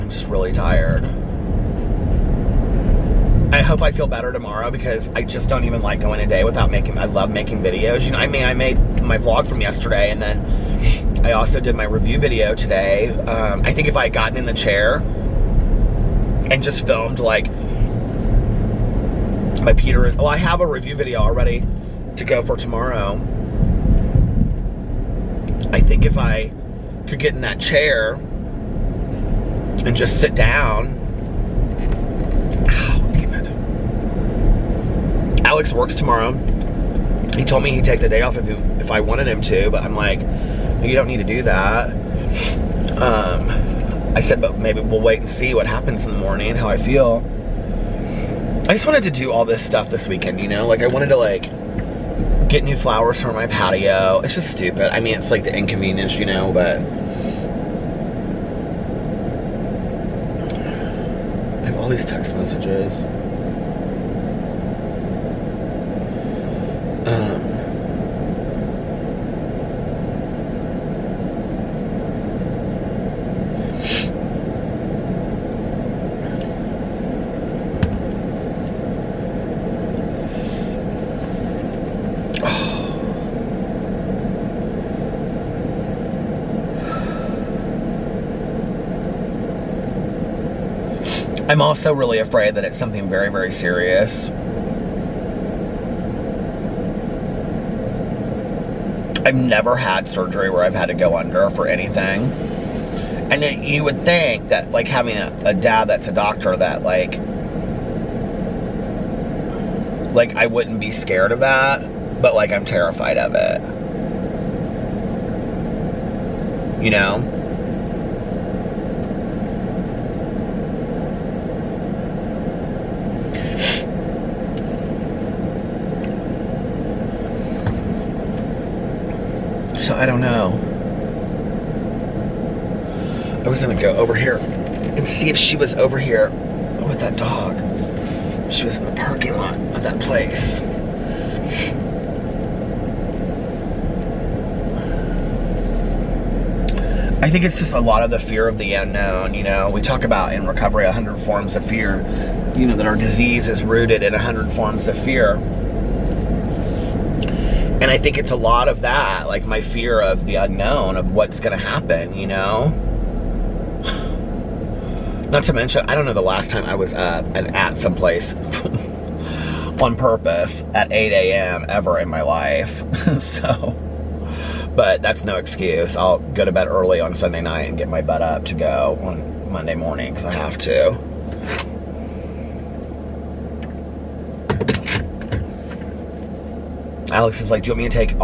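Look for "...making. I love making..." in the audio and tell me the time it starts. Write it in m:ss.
0:06.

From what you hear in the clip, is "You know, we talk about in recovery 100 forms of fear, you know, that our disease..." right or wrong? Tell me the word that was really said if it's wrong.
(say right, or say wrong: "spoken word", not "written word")
right.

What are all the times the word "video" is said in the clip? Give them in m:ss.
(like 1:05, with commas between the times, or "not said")
0:07, 0:12, 0:20.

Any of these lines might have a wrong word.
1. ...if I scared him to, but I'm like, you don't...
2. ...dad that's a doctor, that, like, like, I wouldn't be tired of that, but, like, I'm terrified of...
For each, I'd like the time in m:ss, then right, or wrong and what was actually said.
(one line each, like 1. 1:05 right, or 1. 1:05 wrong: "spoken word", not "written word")
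1. 0:38 wrong: "wanted", not "scared"
2. 1:45 wrong: "scared", not "tired".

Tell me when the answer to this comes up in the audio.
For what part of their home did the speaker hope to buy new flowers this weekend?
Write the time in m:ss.
0:53.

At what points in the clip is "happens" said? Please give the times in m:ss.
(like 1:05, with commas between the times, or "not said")
0:45, 2:41.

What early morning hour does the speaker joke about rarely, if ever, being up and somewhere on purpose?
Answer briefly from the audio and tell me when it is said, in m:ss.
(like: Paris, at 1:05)
8 a.m., at 2:50.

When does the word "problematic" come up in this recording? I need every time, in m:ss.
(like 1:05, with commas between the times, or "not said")
not said.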